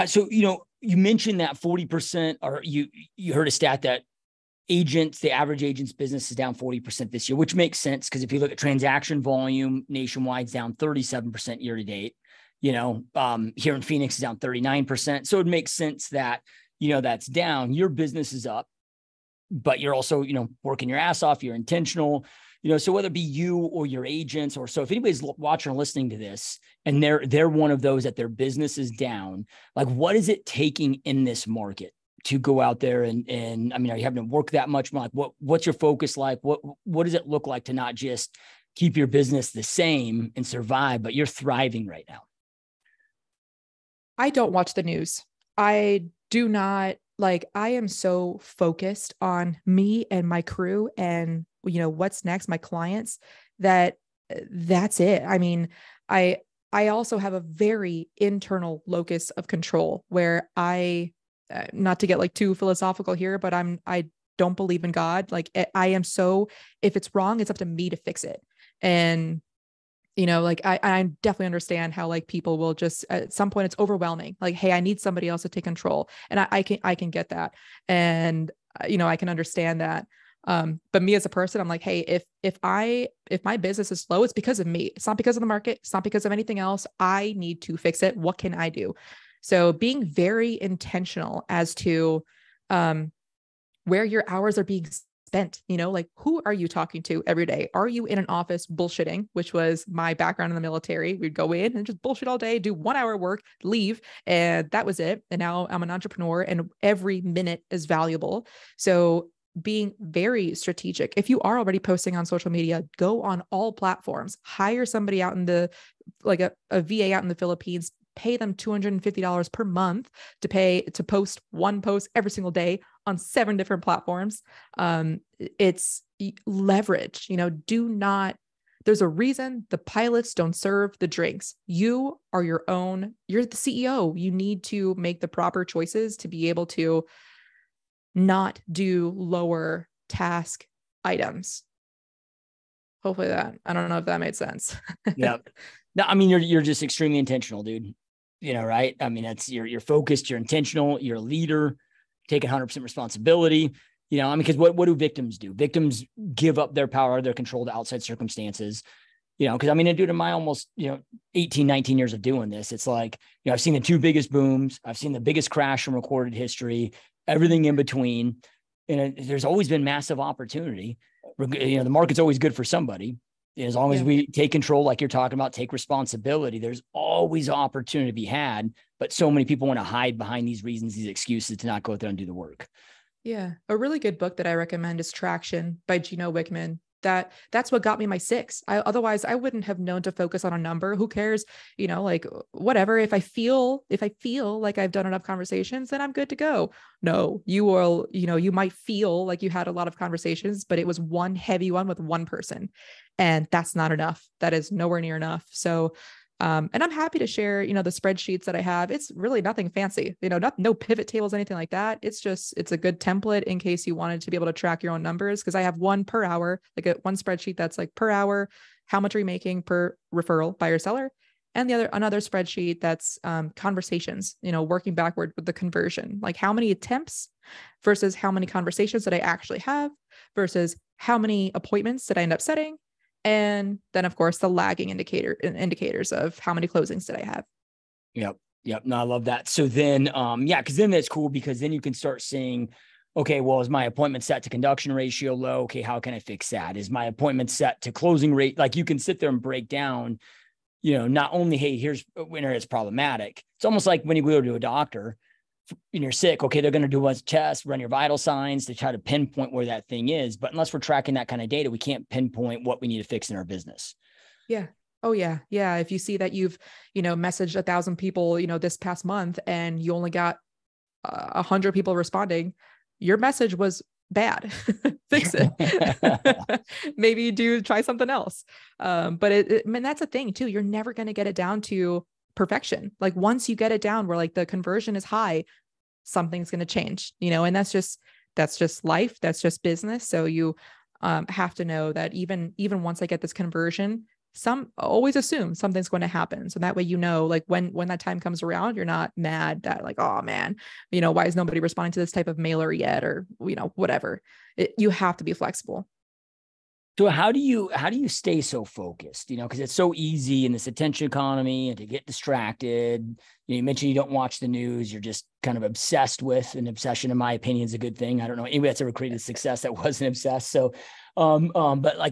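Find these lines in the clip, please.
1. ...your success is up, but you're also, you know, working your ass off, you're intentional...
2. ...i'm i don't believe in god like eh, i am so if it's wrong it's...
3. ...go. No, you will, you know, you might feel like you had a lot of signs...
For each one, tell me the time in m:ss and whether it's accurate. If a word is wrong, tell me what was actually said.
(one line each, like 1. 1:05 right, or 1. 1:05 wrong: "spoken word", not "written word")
1. 0:17 wrong: "business", not "success"
2. 1:03 right
3. 3:16 wrong: "conversations", not "signs".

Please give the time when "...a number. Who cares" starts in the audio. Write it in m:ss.
3:10.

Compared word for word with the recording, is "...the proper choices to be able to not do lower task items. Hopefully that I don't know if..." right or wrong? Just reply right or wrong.
right.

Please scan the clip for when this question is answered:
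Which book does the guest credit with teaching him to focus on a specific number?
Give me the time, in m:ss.
3:05.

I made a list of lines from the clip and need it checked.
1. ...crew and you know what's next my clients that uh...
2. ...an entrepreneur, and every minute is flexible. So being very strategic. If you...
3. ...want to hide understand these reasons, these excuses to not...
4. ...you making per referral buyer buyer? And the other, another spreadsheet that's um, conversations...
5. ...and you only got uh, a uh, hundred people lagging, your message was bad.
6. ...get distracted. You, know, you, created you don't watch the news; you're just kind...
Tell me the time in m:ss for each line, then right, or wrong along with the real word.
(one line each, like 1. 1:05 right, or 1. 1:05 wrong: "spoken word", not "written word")
1. 0:50 right
2. 1:45 wrong: "valuable", not "flexible"
3. 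2:59 wrong: "behind", not "understand"
4. 3:39 wrong: "seller", not "buyer"
5. 4:29 wrong: "responding", not "lagging"
6. 5:11 wrong: "mentioned", not "created".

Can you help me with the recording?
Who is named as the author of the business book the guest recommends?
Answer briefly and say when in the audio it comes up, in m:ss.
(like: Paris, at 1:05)
Gino Wickman, at 3:05.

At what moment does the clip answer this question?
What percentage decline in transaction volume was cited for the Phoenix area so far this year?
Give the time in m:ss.
0:14.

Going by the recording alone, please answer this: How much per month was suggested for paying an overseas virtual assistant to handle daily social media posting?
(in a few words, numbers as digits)
$250.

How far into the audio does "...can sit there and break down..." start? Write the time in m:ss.
4:08.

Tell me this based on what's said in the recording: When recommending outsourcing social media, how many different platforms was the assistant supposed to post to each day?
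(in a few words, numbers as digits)
7.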